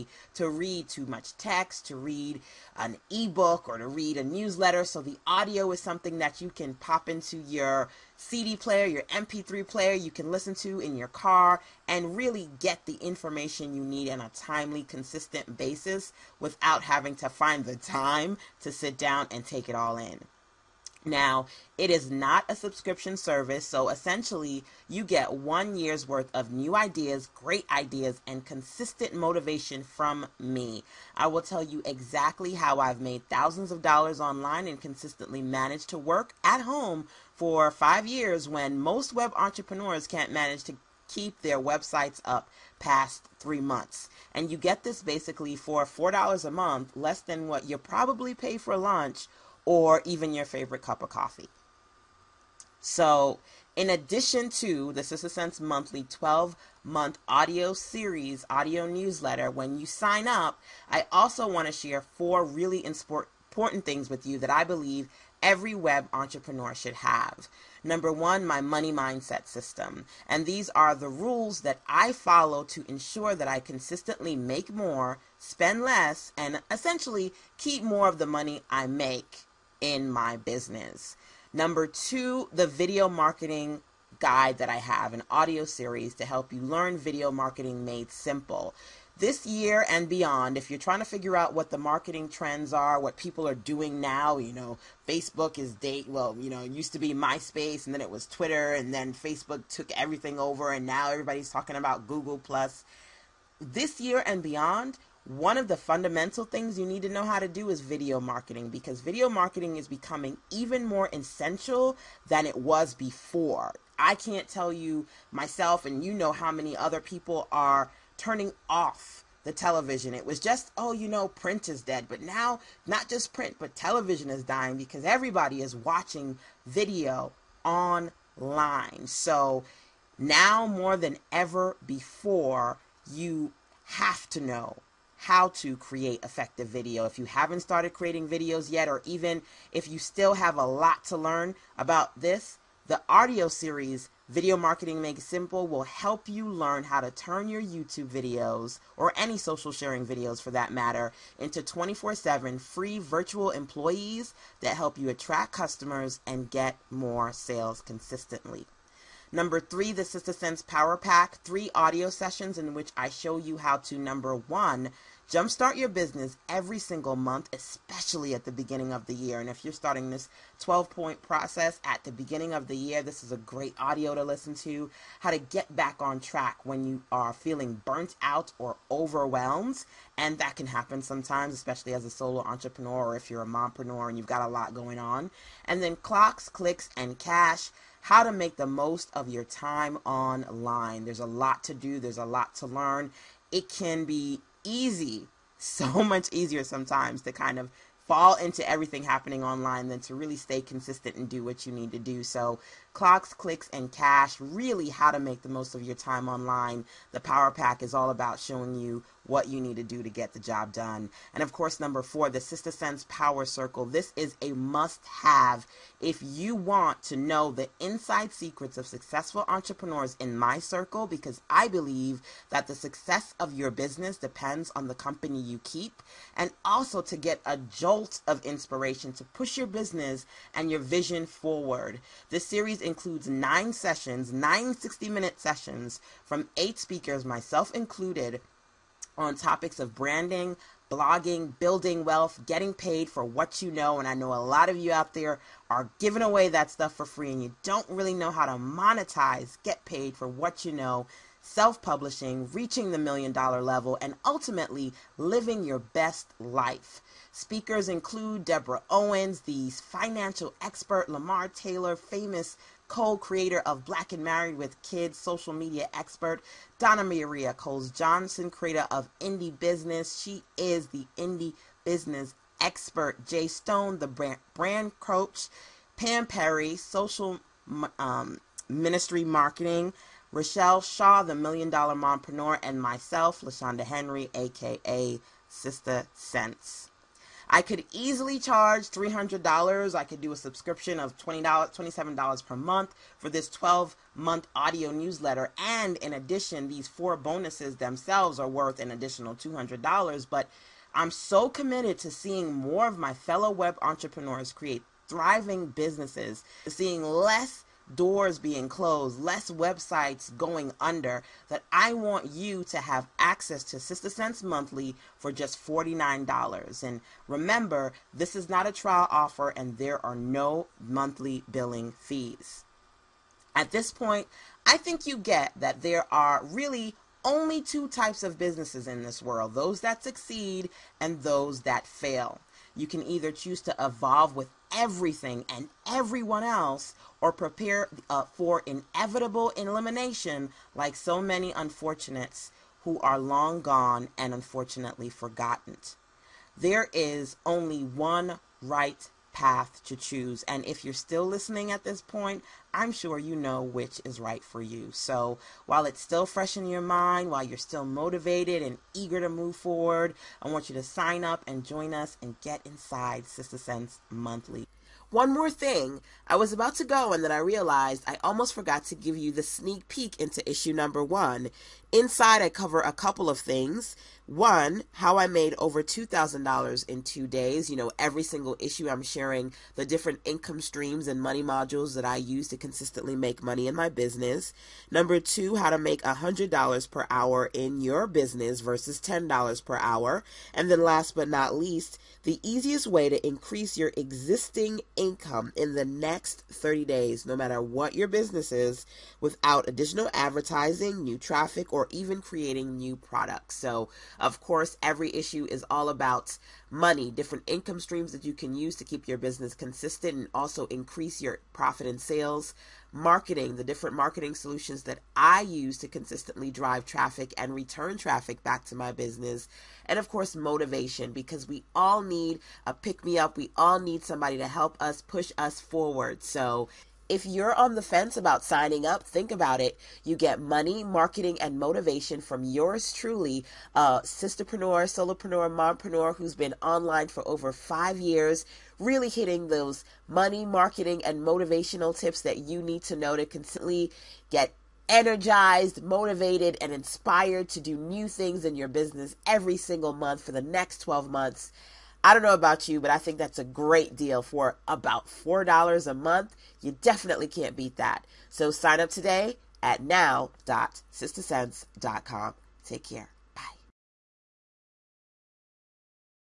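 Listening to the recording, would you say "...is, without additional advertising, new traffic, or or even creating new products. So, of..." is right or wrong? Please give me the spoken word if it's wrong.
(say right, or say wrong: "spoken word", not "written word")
right.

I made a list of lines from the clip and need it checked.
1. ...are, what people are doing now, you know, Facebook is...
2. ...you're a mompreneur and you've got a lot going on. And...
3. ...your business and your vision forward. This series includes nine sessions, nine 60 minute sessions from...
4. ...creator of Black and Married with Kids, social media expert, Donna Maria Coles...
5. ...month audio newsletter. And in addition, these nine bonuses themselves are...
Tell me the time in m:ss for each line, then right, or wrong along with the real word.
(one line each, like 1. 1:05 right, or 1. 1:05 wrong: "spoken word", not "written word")
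1. 1:32 right
2. 3:03 right
3. 3:49 right
4. 4:23 right
5. 4:54 wrong: "four", not "nine".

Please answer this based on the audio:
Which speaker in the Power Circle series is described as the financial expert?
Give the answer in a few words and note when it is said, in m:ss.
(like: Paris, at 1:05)
Deborah Owens, at 4:18.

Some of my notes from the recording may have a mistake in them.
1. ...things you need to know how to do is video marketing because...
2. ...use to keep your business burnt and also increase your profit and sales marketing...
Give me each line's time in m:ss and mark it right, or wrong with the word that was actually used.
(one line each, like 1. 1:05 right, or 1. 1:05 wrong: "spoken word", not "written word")
1. 1:46 right
2. 6:48 wrong: "consistent", not "burnt".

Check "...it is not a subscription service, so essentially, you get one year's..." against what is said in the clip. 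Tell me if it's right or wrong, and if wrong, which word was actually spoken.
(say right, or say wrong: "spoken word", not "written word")
right.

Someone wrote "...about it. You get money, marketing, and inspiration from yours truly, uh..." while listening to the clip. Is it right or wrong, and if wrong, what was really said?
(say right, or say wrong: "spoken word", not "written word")
wrong: "motivation", not "inspiration".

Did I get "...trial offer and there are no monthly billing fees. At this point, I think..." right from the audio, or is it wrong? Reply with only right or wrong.
right.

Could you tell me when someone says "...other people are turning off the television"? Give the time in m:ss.
1:56.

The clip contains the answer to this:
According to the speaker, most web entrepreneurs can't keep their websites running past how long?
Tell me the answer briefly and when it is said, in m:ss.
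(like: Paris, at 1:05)
3 months, at 0:43.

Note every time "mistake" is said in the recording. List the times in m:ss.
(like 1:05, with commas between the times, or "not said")
not said.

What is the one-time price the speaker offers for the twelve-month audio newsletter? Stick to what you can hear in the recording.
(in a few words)
$49.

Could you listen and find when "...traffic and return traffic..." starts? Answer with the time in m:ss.
6:56.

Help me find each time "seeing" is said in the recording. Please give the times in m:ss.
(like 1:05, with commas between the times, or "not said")
5:02, 5:06.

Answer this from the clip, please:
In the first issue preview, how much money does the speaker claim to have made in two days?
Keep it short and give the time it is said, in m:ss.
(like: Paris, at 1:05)
$2,000, at 6:15.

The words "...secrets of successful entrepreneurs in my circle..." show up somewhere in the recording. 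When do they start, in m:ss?
3:38.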